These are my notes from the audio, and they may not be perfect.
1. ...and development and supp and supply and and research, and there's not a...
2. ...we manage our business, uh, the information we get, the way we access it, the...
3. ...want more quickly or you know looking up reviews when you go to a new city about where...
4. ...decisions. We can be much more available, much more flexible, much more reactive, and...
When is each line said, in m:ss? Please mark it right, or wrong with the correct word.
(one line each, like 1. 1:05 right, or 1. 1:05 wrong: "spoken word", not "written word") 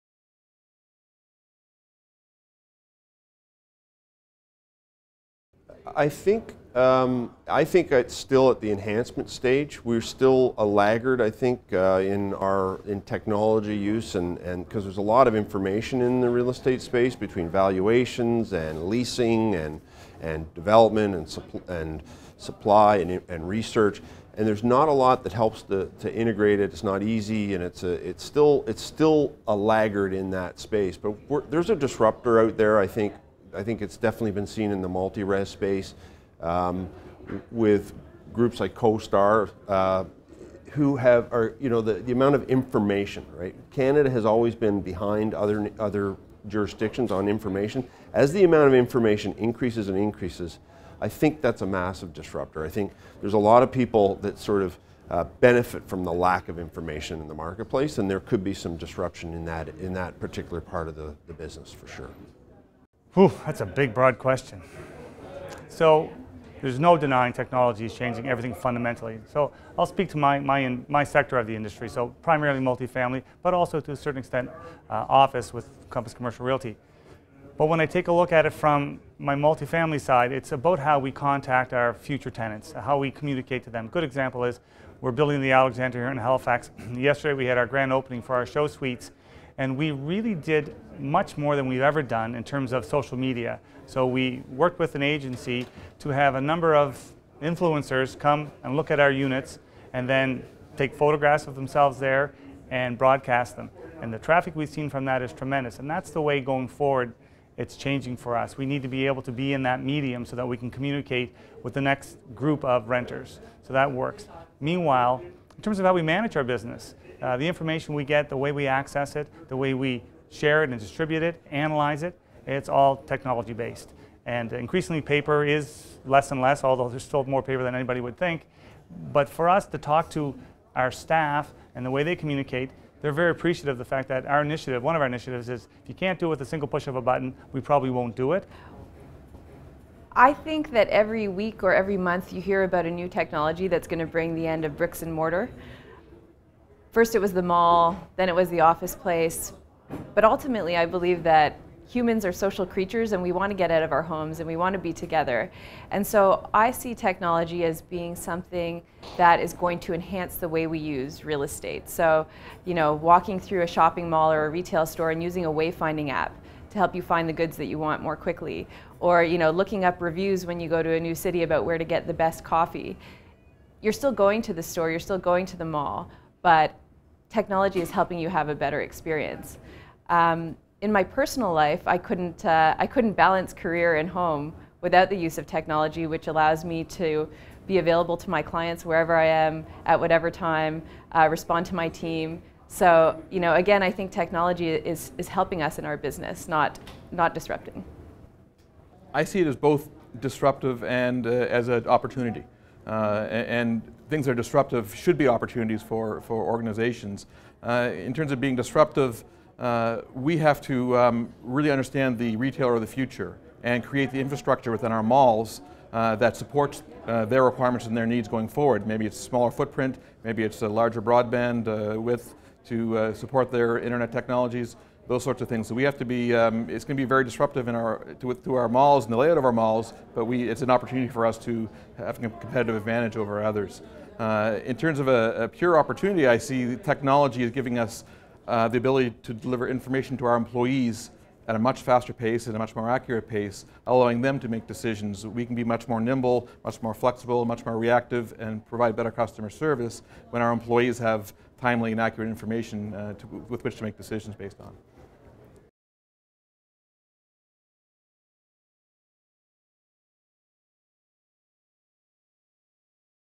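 1. 0:20 right
2. 1:55 right
3. 2:47 right
4. 4:04 wrong: "nimble", not "available".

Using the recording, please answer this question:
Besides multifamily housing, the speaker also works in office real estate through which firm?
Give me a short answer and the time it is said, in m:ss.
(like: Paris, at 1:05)
Compass Commercial Realty, at 1:15.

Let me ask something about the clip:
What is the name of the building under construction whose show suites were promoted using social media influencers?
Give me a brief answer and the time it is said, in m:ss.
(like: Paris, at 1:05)
the Alexander, at 1:25.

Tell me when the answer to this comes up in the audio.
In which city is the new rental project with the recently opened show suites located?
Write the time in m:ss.
1:26.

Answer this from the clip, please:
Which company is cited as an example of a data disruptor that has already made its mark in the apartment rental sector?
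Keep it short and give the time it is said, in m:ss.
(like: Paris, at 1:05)
CoStar, at 0:38.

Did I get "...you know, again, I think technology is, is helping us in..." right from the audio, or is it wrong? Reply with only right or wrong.
right.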